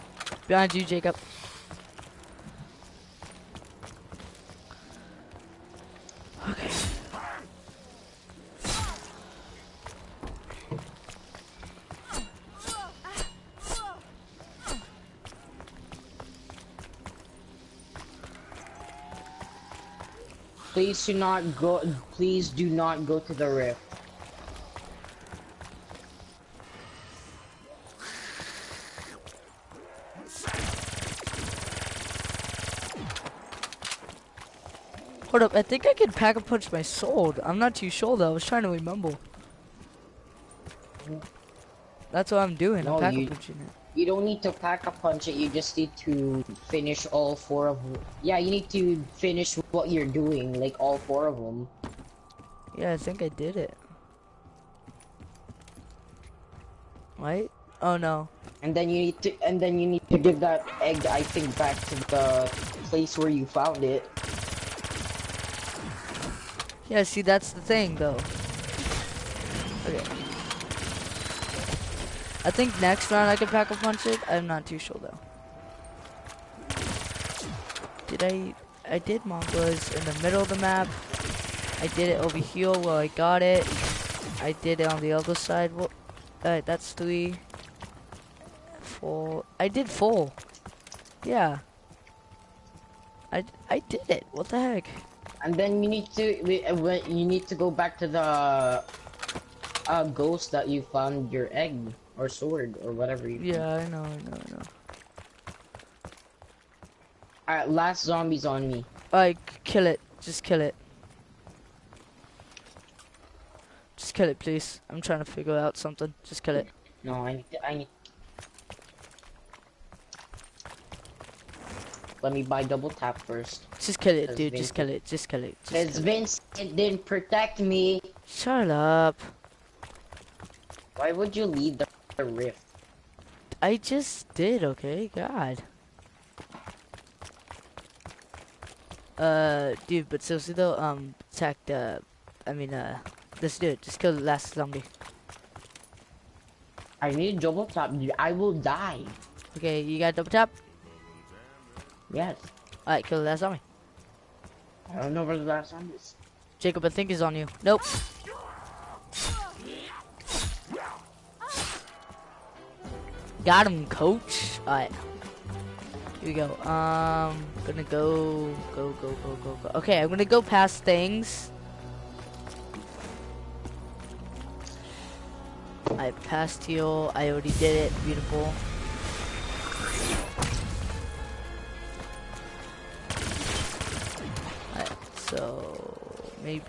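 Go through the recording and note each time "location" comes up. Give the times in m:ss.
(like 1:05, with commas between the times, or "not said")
not said.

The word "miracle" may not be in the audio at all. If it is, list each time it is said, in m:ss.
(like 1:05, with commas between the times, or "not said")
not said.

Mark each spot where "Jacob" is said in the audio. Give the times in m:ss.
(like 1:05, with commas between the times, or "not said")
0:00, 2:36.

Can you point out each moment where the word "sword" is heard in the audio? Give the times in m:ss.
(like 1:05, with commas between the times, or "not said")
1:42.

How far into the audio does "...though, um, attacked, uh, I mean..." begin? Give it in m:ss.
2:20.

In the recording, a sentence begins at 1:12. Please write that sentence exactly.
I think next round I can pack a punch it.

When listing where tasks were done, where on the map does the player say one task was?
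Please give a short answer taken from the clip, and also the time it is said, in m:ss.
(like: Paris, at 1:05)
In the middle, at 1:19.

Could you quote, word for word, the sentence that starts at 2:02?
Let me buy double tap first.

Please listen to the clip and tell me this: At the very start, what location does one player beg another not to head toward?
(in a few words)
The rift.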